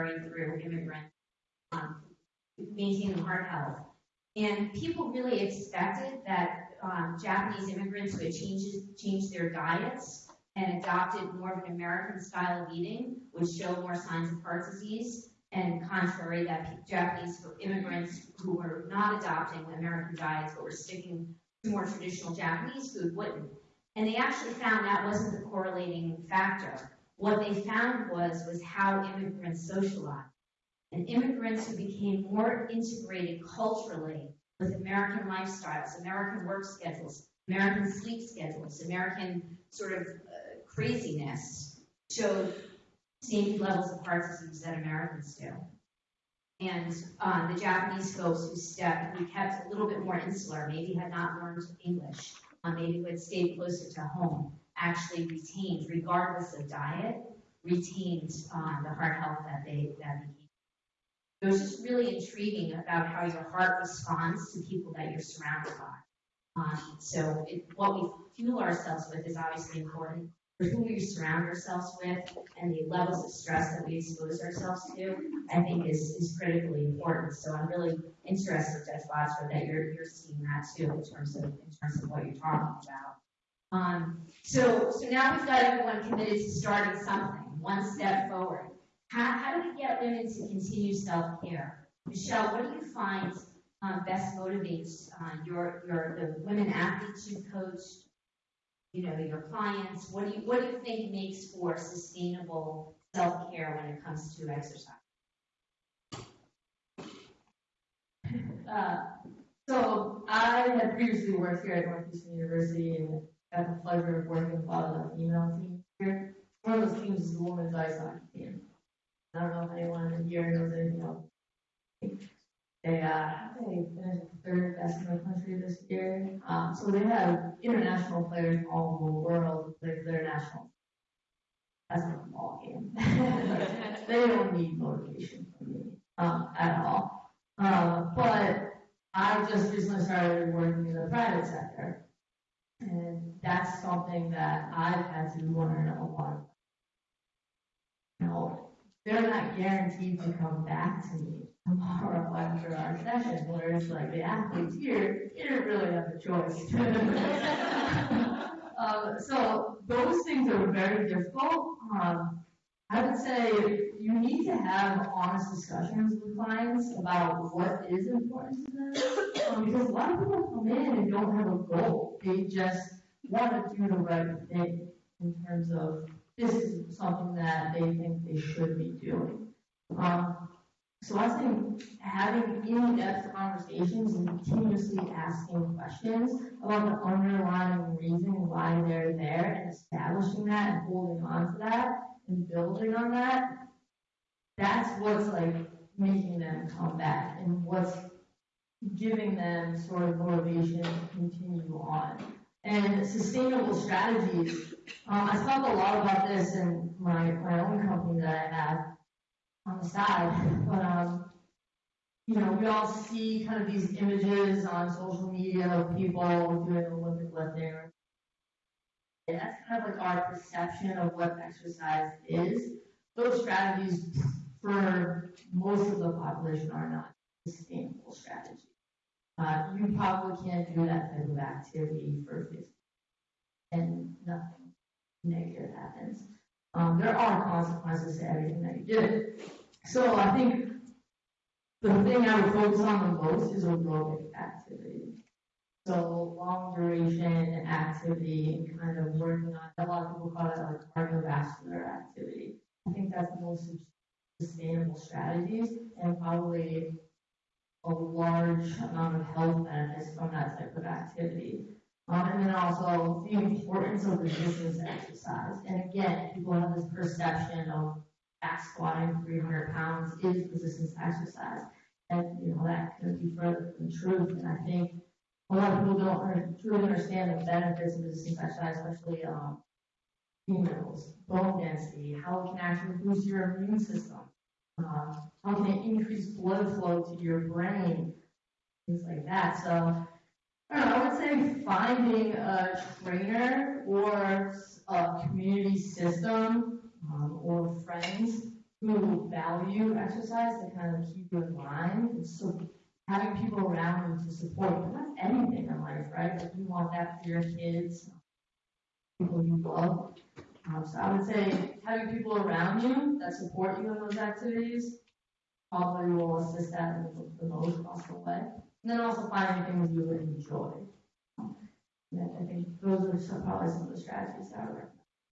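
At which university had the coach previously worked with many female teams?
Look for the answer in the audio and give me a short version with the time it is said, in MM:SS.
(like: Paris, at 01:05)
Northeastern University, at 01:51.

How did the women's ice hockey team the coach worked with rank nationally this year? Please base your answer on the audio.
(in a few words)
third best.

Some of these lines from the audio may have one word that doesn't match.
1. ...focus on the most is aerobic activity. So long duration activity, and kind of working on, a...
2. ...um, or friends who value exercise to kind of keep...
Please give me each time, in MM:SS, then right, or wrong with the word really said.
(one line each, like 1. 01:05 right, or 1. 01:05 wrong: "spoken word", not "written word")
1. 04:02 right
2. 04:57 right.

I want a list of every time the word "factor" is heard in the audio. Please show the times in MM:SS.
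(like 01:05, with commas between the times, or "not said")
00:26.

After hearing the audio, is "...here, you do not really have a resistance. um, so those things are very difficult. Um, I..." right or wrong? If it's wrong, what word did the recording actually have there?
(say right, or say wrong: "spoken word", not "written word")
wrong: "choice", not "resistance".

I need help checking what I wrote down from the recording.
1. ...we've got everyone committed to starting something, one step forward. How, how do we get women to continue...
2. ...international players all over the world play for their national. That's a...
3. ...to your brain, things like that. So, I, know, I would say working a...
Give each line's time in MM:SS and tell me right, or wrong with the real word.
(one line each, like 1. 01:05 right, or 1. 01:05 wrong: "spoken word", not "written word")
1. 01:25 right
2. 02:07 right
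3. 04:47 wrong: "finding", not "working".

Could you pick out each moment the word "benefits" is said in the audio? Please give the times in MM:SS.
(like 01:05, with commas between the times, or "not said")
04:19, 04:37.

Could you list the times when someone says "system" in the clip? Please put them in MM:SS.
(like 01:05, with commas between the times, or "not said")
04:43, 04:55.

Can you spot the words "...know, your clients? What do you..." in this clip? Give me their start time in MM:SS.
01:39.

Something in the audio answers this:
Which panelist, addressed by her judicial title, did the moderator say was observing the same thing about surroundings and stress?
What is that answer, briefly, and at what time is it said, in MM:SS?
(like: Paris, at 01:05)
Judge Botsford, at 01:18.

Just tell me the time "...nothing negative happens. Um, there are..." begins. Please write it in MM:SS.
03:54.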